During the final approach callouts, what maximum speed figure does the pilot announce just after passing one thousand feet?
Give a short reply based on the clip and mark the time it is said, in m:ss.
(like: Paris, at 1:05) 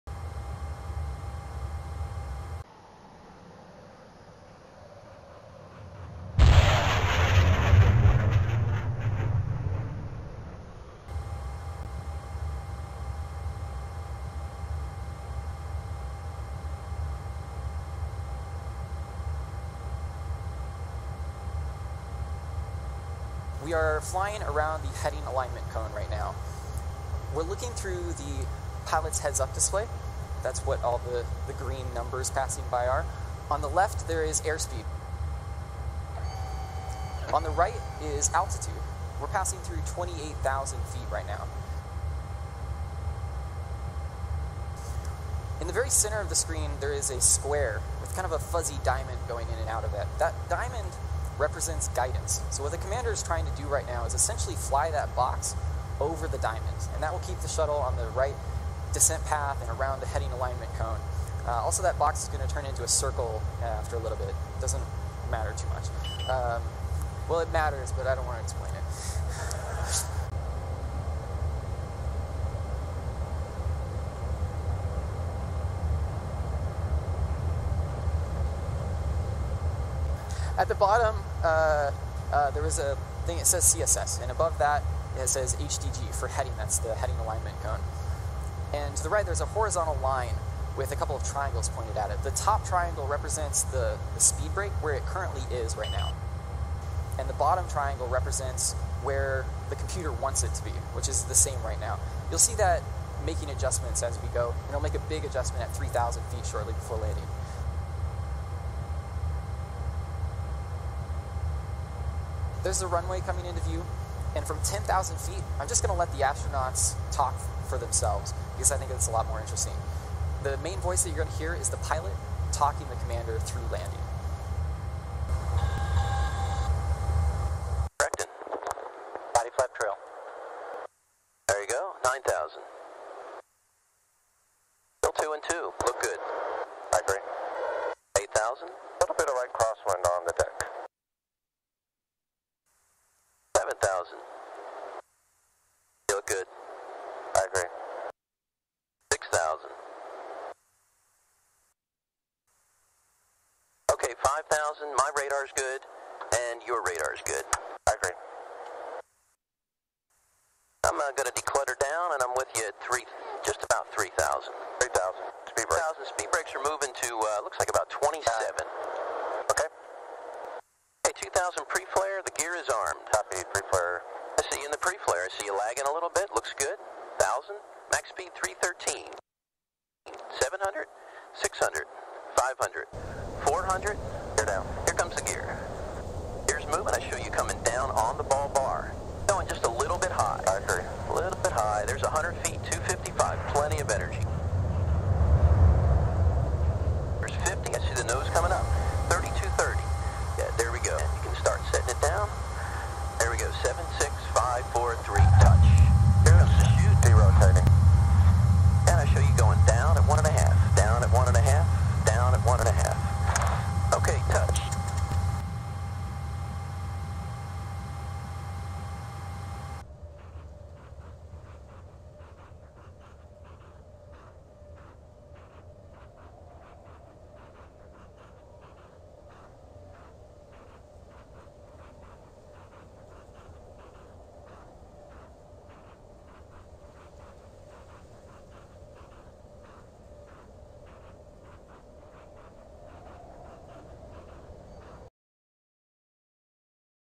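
313, at 2:58.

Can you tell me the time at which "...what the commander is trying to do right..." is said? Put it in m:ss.
0:52.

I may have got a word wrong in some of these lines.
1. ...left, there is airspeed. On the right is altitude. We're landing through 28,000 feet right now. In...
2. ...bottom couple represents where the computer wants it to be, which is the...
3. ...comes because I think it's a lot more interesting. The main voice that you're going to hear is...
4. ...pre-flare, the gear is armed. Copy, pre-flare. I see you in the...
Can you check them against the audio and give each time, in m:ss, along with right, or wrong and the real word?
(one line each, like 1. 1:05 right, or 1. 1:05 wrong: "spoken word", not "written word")
1. 0:33 wrong: "passing", not "landing"
2. 1:37 wrong: "triangle", not "couple"
3. 1:57 wrong: "themselves", not "comes"
4. 2:51 right.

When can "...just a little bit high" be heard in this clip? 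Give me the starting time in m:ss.
3:09.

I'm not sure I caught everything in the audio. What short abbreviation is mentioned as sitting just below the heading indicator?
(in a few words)
CSS.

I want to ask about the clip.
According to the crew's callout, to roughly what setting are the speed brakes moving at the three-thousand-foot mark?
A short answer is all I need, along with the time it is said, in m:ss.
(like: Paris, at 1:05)
27, at 2:47.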